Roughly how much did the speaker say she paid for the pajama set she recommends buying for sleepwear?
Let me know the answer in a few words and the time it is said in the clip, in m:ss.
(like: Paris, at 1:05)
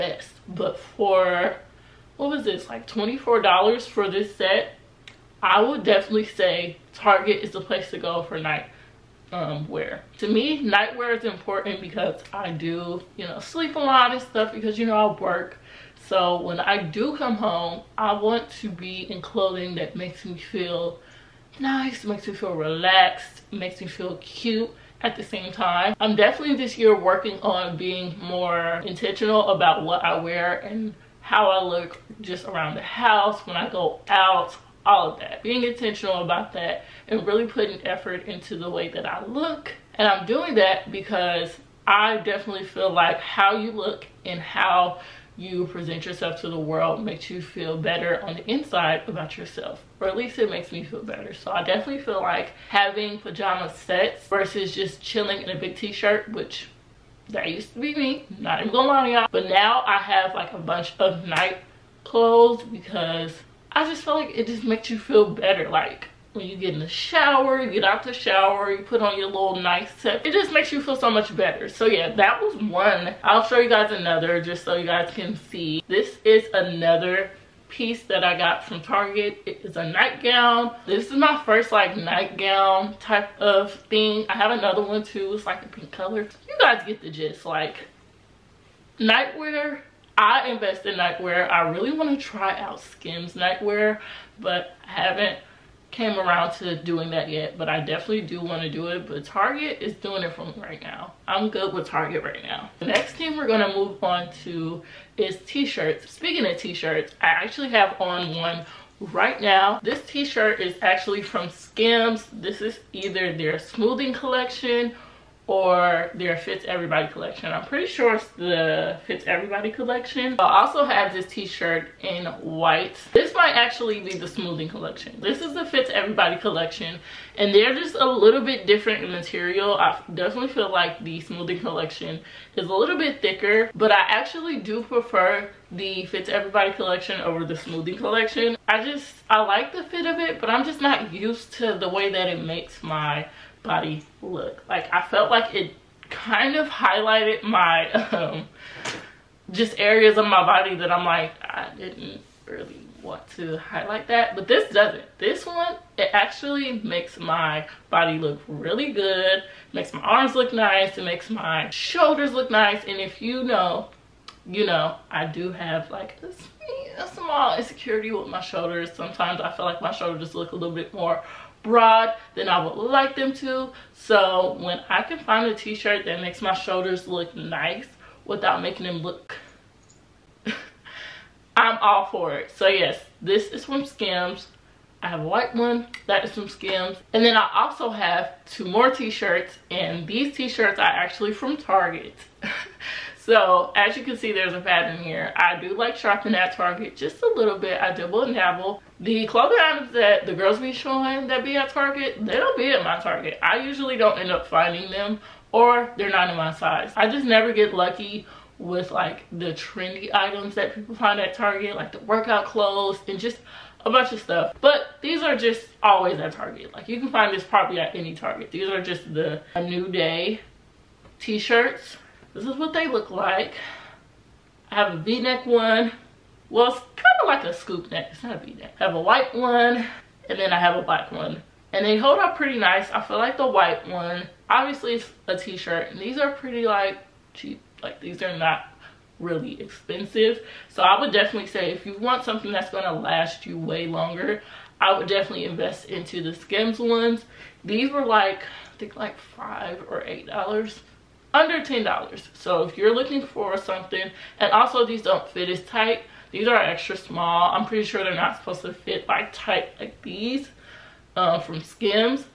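$24, at 0:02.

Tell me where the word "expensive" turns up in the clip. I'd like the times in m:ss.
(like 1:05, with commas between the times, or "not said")
3:59.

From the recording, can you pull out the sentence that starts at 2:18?
I just, I like the fit of it but I'm just not used to the way that it makes my body look.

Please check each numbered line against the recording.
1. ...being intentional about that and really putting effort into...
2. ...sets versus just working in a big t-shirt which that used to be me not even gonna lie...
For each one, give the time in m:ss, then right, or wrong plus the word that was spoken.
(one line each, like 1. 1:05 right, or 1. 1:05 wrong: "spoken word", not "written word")
1. 0:35 right
2. 0:53 wrong: "chilling", not "working".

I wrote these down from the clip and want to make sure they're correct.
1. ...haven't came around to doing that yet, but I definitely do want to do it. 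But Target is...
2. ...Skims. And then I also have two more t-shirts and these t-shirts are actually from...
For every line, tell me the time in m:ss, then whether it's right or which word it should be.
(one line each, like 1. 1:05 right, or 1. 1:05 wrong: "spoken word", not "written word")
1. 1:34 right
2. 3:06 right.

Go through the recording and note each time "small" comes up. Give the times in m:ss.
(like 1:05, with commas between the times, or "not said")
2:47, 4:16.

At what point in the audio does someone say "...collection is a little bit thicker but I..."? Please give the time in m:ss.
2:11.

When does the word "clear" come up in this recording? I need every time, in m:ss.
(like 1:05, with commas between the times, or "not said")
not said.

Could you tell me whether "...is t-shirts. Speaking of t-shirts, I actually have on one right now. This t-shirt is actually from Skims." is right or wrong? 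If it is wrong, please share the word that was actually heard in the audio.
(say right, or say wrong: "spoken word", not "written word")
right.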